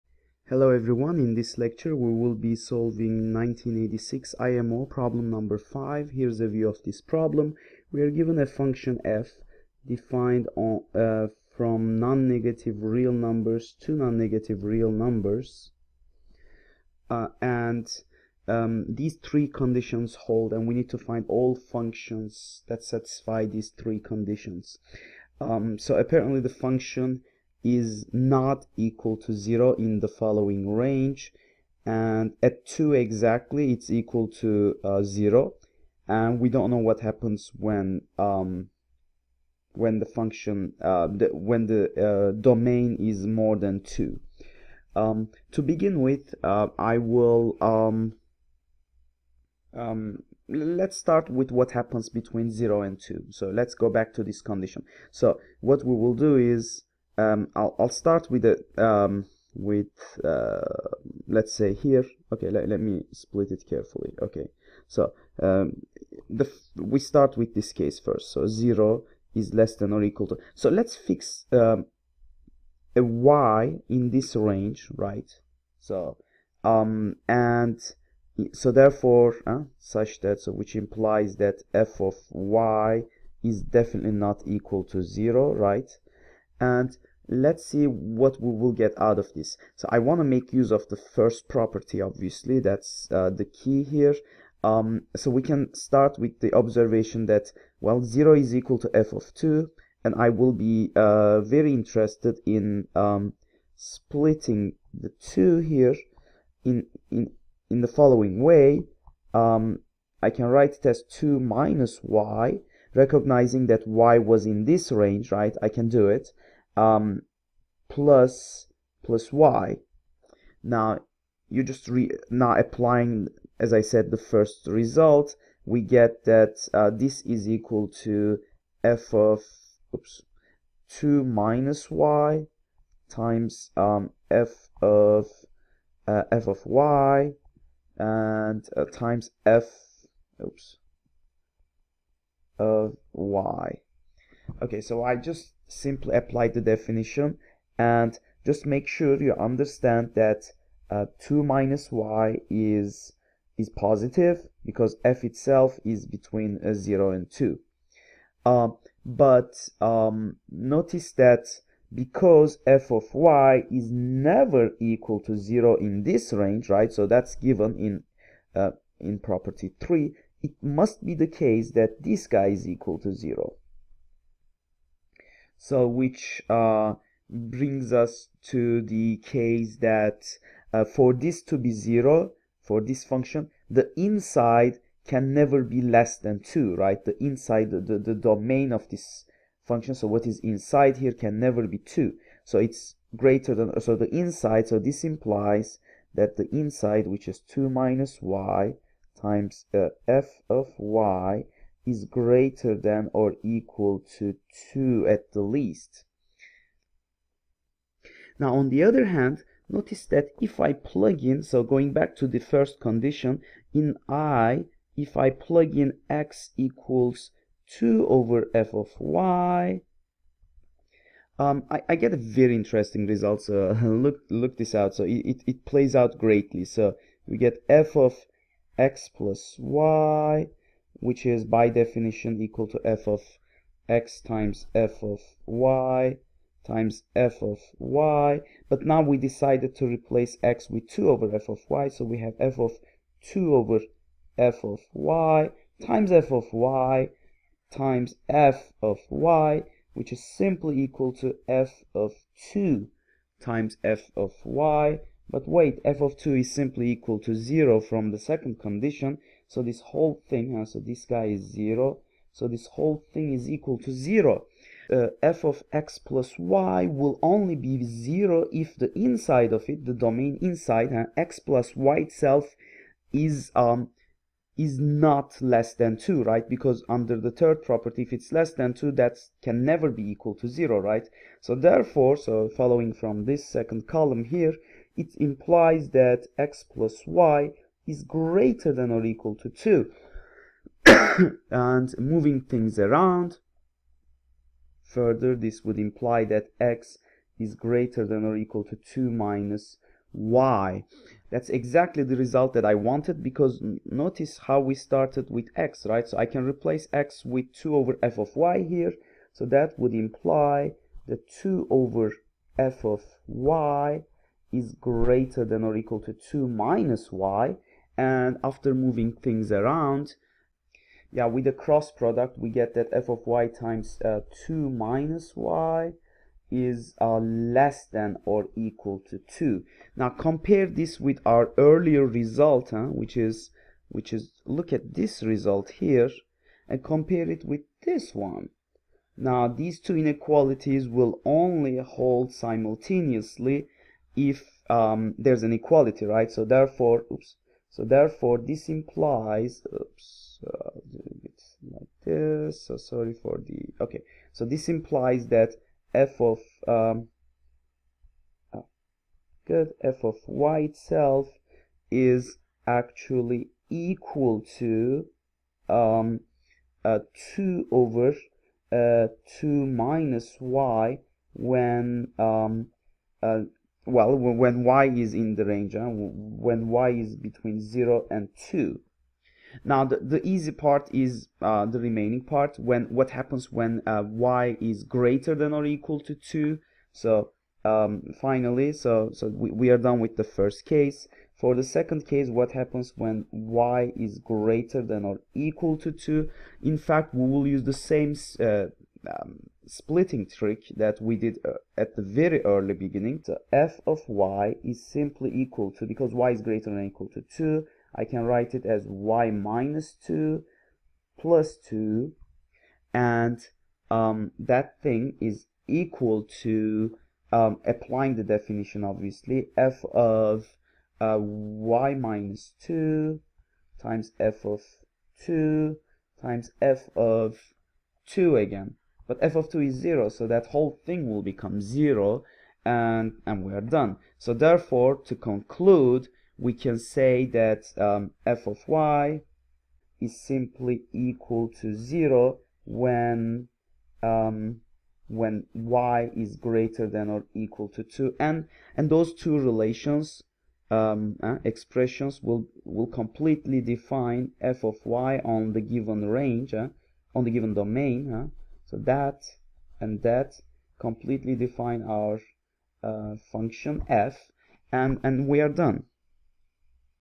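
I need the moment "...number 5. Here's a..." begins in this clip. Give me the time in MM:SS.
00:05.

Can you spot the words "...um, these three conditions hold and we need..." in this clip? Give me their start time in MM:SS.
00:18.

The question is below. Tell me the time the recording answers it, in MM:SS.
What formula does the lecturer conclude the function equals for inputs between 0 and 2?
06:07.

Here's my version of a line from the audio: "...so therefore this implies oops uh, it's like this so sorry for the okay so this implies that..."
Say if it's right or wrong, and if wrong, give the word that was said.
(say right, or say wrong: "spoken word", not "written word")
right.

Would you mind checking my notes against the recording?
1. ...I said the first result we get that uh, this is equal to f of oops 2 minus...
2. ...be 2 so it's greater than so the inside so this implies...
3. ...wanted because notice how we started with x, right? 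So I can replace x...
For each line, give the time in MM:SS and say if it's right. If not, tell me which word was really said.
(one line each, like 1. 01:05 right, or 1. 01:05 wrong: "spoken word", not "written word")
1. 02:03 right
2. 03:11 right
3. 05:02 right.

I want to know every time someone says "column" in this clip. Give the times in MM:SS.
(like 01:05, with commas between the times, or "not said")
04:43.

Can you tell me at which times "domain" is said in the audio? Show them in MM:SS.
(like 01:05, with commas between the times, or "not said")
00:42, 03:08, 04:29, 07:37.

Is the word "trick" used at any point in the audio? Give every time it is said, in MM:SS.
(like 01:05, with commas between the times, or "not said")
06:40.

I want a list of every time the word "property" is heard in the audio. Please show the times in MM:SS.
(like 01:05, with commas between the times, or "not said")
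01:31, 02:49, 04:37.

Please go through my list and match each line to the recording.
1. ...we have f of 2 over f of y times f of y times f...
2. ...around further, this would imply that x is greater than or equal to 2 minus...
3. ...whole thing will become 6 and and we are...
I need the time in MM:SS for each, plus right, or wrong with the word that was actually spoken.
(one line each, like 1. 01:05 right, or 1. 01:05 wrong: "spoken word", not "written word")
1. 04:02 right
2. 04:52 right
3. 07:10 wrong: "0", not "6".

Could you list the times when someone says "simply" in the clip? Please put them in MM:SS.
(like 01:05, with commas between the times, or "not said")
02:25, 04:10, 04:16, 06:44, 07:20.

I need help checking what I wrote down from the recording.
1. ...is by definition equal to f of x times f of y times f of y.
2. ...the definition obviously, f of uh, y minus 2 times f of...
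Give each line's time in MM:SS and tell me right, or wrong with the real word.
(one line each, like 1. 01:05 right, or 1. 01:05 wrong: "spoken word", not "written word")
1. 03:51 right
2. 06:58 right.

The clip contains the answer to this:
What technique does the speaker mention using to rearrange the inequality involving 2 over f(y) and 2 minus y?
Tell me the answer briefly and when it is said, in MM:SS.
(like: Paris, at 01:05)
cross product, at 05:21.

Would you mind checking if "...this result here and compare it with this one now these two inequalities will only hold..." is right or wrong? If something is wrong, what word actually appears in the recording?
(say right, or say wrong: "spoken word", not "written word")
right.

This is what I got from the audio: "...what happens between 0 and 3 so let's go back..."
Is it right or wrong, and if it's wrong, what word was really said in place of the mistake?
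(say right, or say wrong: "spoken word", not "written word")
wrong: "2", not "3".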